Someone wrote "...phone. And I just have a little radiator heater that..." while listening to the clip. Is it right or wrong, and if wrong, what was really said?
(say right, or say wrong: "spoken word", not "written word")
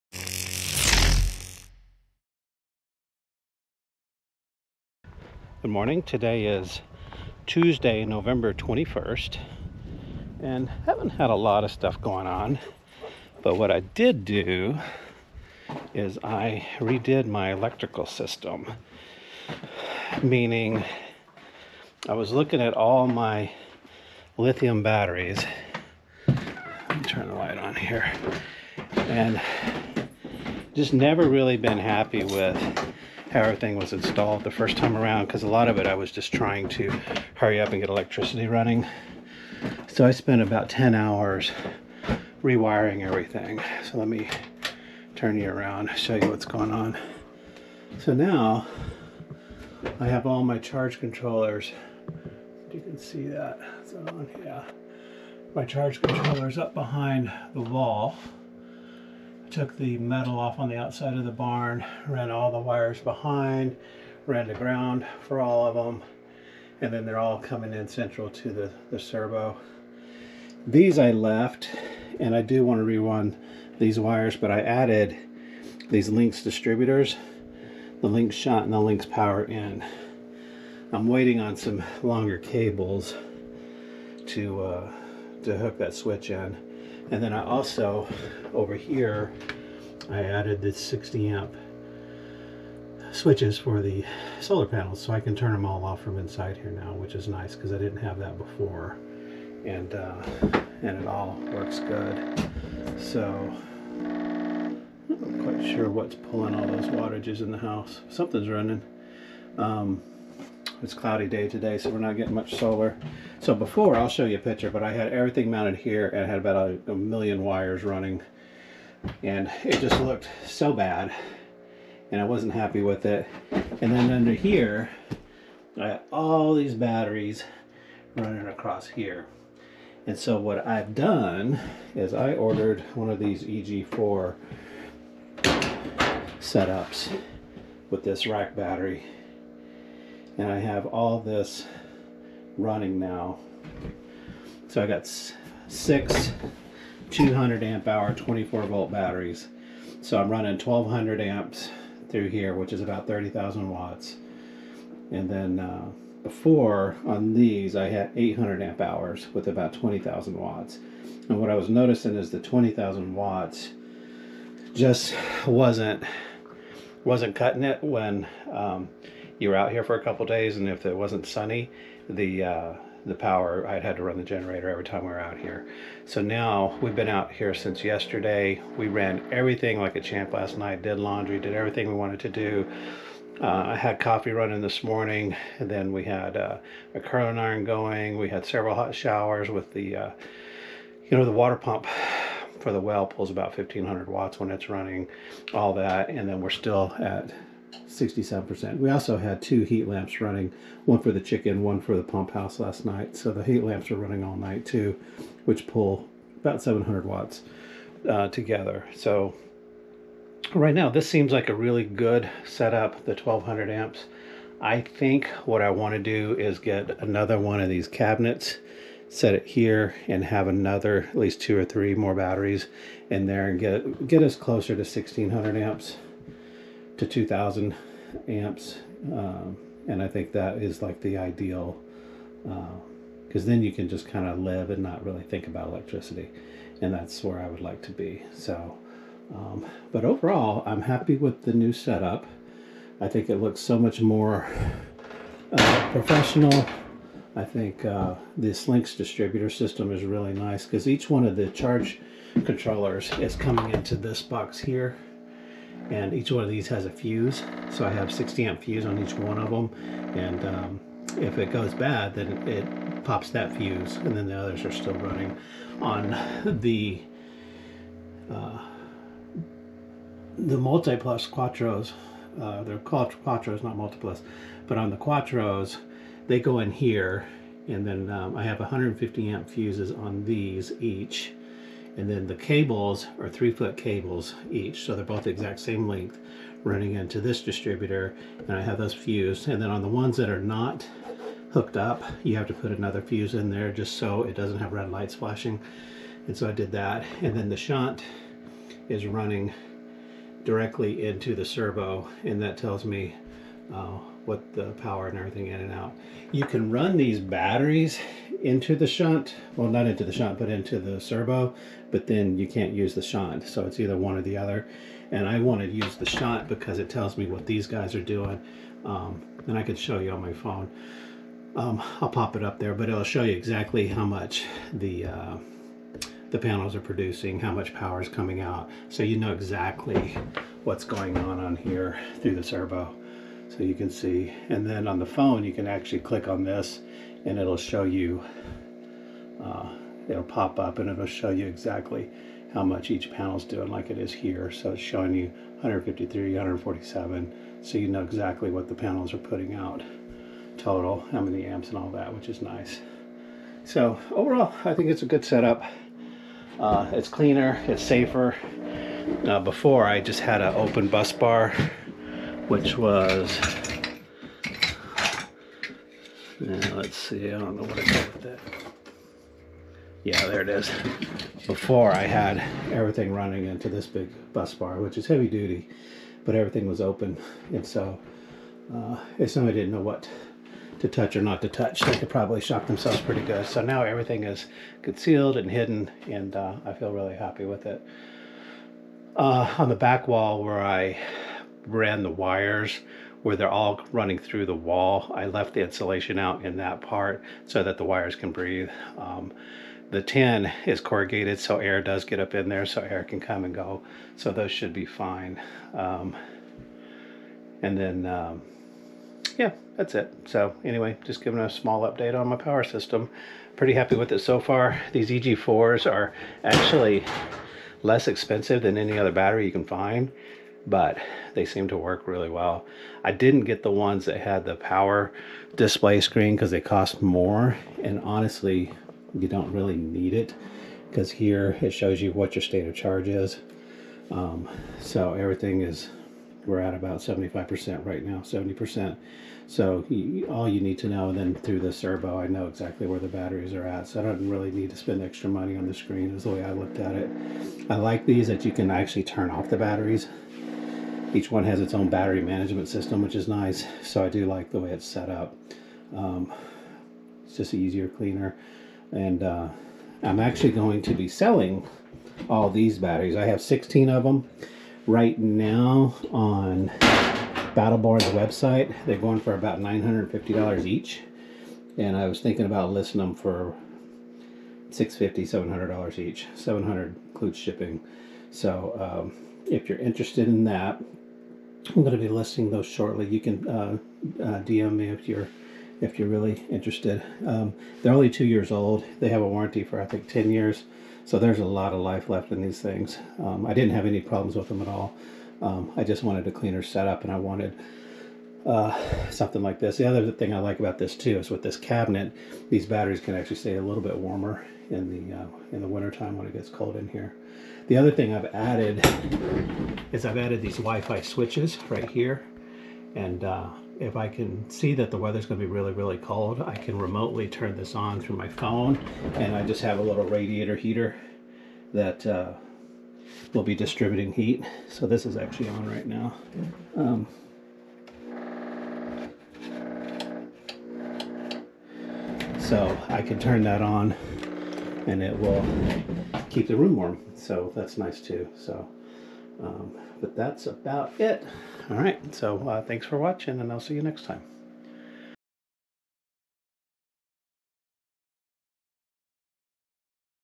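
right.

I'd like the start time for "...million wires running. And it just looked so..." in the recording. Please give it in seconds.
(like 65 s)
116 s.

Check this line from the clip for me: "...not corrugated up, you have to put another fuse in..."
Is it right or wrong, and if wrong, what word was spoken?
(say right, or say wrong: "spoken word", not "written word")
wrong: "hooked", not "corrugated".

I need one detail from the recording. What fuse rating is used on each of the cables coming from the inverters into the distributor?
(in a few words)
150 amp.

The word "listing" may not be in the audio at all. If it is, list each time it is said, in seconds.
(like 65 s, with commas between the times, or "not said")
472 s, 482 s.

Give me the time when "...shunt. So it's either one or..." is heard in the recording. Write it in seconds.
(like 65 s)
313 s.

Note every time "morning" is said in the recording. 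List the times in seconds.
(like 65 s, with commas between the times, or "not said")
5 s, 184 s.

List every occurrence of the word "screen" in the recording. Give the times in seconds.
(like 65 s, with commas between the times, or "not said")
426 s, 445 s.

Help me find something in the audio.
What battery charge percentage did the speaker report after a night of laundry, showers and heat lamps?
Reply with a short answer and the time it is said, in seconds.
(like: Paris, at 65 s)
67%, at 197 s.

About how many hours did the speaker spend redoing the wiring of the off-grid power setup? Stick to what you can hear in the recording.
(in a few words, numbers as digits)
10.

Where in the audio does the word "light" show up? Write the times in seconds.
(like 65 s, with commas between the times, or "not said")
27 s, 294 s.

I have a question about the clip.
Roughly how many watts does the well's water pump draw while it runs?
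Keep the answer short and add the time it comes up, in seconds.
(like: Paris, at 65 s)
1500 watts, at 193 s.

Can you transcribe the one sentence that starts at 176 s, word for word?
So now we've been out here since yesterday.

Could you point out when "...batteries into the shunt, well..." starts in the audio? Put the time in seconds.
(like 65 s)
307 s.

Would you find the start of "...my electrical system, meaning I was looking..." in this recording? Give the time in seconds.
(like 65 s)
17 s.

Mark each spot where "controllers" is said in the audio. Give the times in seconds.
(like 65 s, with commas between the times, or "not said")
50 s, 56 s, 252 s.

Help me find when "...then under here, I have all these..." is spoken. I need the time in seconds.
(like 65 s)
123 s.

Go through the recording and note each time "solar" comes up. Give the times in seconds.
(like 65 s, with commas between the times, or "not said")
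94 s, 112 s.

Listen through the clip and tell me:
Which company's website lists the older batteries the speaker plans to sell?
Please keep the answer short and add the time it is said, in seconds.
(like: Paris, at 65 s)
Battle Born, at 467 s.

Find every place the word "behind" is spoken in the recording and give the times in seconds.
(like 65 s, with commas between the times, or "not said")
56 s, 63 s.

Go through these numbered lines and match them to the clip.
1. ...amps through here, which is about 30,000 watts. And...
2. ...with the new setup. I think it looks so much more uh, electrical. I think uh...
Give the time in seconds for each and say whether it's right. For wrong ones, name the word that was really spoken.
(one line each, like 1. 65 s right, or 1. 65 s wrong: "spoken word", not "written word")
1. 151 s right
2. 241 s wrong: "professional", not "electrical".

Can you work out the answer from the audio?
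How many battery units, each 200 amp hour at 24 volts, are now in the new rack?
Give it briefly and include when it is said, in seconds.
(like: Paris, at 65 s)
6, at 145 s.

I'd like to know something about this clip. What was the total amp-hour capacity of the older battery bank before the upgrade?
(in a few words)
800 amp hours.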